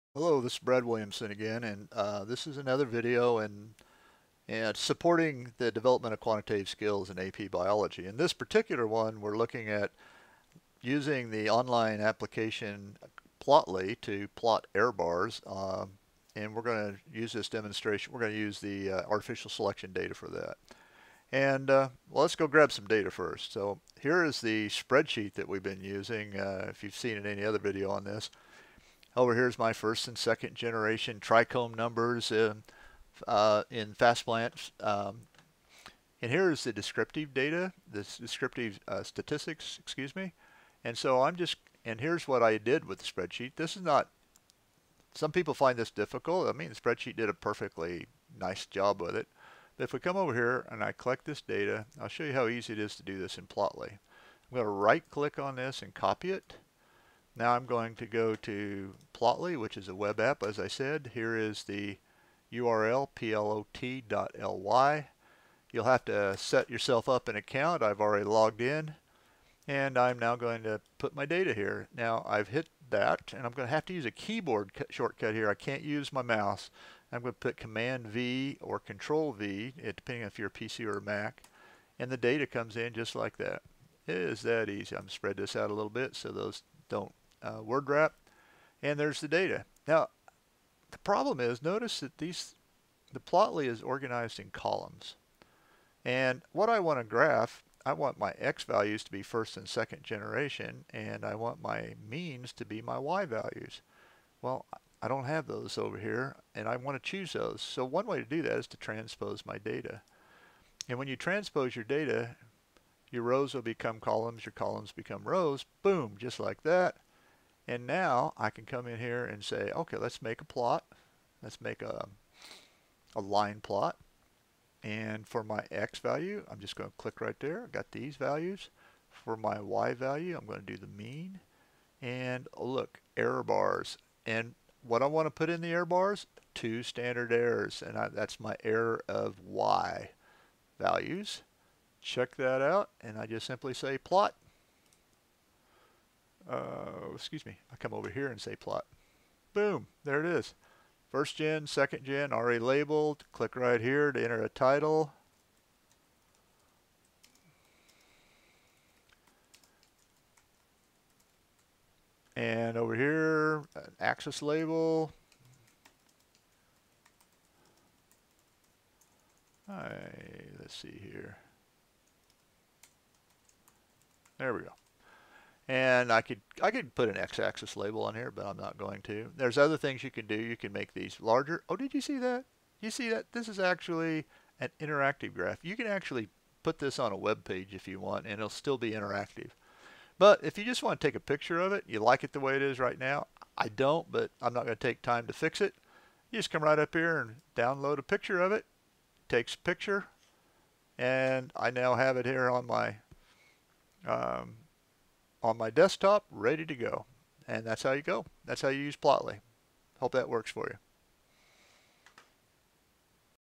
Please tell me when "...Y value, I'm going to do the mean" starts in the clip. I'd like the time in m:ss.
2:09.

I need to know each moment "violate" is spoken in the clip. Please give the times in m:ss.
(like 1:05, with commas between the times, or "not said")
not said.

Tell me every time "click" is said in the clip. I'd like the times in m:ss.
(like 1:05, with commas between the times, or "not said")
0:55, 2:06, 2:33.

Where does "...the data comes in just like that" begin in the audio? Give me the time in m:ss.
1:22.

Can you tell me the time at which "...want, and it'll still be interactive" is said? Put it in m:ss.
3:08.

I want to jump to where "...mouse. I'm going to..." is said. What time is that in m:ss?
1:16.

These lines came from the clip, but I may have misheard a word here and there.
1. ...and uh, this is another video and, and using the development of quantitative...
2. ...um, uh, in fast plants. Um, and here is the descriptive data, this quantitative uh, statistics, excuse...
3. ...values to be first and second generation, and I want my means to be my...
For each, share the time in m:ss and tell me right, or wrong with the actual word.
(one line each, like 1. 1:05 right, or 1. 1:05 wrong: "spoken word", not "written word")
1. 0:01 wrong: "supporting", not "using"
2. 0:32 wrong: "descriptive", not "quantitative"
3. 1:38 right.